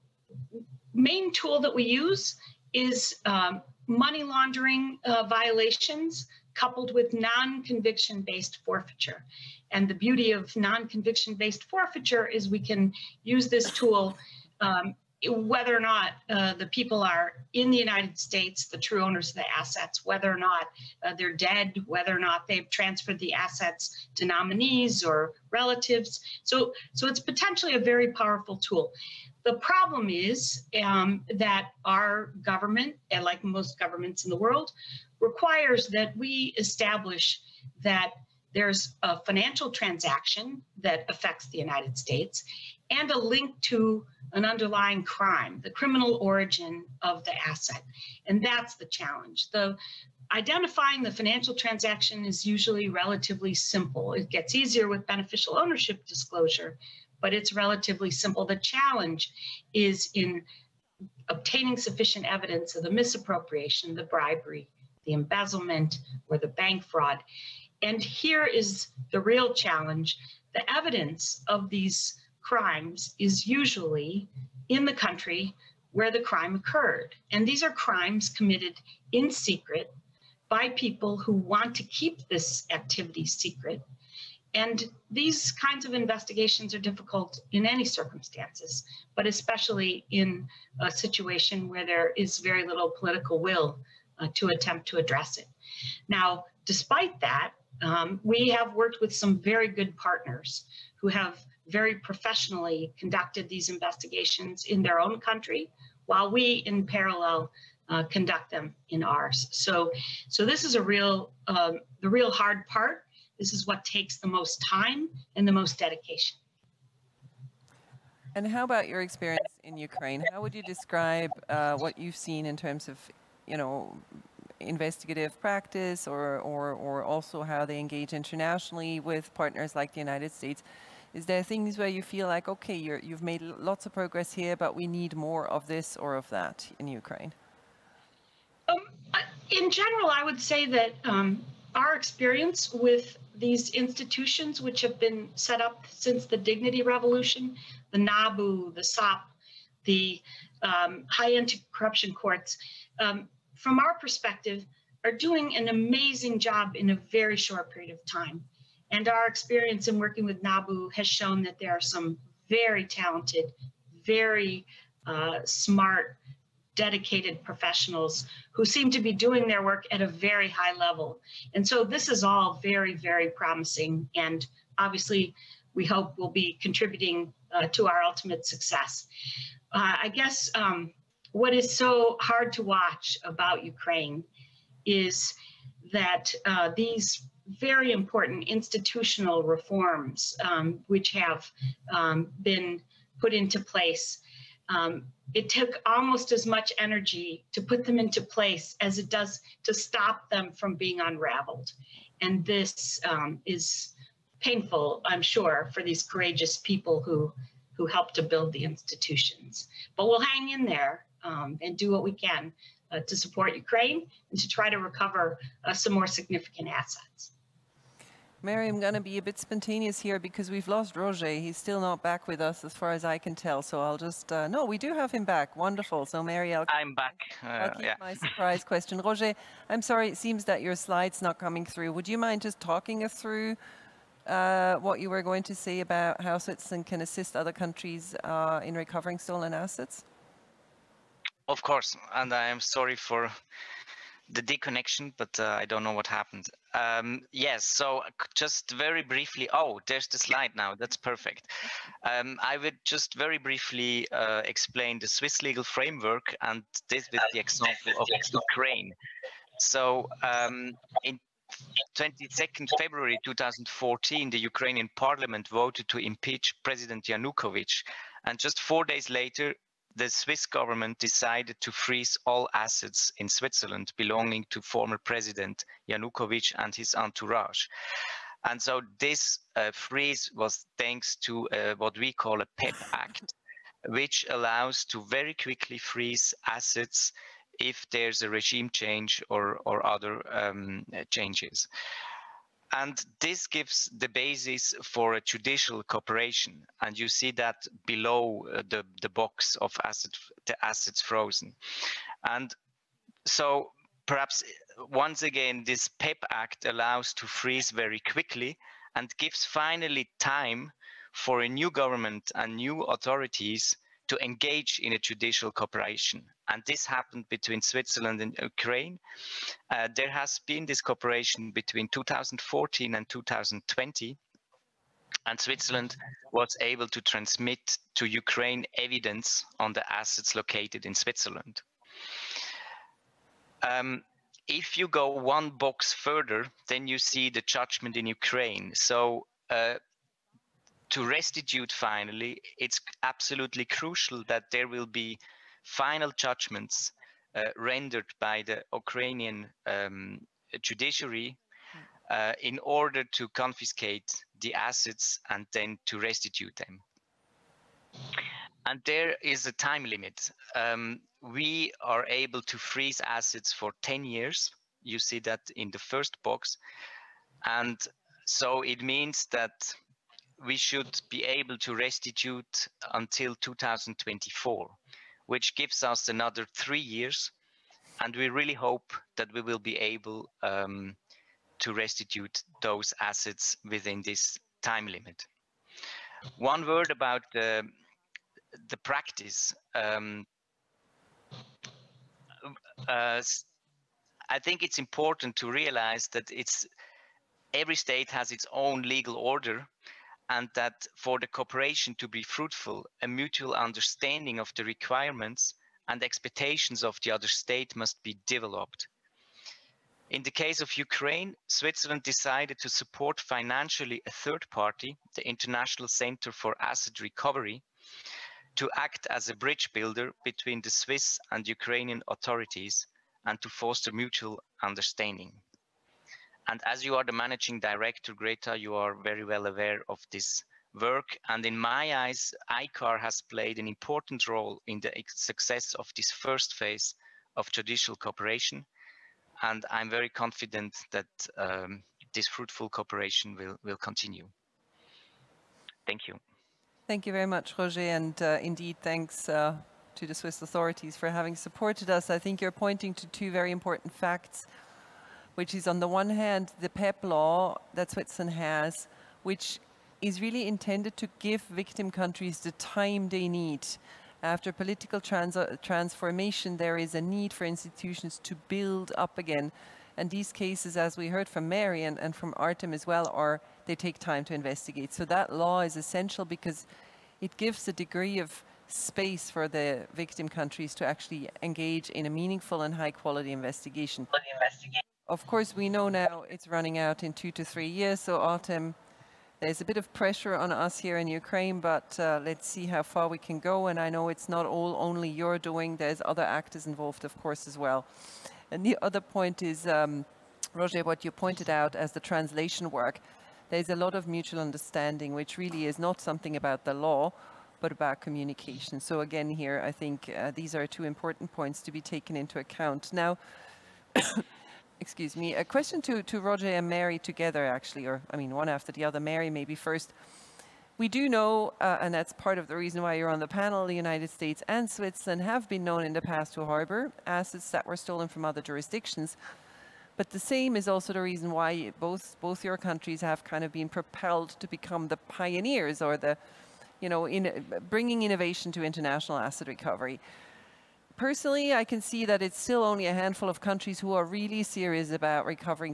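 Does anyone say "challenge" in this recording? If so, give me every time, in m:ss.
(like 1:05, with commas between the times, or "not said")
0:48, 0:58, 1:09.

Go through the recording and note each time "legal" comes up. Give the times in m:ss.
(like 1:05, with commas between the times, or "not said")
4:15, 6:38.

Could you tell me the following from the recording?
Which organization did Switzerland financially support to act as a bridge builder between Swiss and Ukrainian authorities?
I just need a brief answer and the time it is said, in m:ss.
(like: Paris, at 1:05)
International Center for Asset Recovery, at 6:55.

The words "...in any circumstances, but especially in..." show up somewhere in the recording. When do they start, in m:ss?
1:27.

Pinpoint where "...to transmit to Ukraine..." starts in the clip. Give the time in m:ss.
5:26.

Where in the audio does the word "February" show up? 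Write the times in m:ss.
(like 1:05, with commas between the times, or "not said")
4:22.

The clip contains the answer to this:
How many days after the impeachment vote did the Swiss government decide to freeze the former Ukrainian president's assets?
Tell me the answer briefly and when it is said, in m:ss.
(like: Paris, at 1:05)
4, at 4:28.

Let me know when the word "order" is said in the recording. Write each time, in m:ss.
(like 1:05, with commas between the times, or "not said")
5:52, 6:39.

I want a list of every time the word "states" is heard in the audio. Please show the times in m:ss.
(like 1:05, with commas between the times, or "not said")
0:18, 0:41, 2:10, 6:37, 6:47, 8:44.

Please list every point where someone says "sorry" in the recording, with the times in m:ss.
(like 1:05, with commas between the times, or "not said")
3:49, 4:02.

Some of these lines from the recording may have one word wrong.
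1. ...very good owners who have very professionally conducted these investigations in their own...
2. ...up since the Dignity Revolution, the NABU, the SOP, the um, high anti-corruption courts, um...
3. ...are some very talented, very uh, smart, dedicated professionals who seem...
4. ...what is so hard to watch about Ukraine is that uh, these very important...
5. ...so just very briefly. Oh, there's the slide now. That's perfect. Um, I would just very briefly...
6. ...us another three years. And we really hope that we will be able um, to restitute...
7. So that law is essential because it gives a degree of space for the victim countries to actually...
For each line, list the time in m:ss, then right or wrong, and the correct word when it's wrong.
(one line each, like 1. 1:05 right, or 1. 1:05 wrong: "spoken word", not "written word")
1. 1:39 wrong: "partners", not "owners"
2. 2:25 right
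3. 2:41 right
4. 3:01 right
5. 4:07 right
6. 6:15 right
7. 7:54 right.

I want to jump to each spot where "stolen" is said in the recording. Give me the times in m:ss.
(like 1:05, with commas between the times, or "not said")
3:59, 8:47.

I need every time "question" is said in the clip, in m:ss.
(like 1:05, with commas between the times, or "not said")
3:48, 8:35.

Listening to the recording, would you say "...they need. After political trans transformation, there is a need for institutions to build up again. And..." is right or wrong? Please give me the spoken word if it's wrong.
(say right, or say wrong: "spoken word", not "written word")
right.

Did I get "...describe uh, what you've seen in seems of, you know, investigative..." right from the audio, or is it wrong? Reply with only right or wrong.
wrong.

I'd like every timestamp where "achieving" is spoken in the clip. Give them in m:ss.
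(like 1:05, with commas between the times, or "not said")
not said.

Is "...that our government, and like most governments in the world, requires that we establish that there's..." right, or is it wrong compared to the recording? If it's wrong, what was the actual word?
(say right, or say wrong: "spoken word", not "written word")
right.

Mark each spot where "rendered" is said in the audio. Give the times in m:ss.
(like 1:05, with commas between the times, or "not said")
5:47.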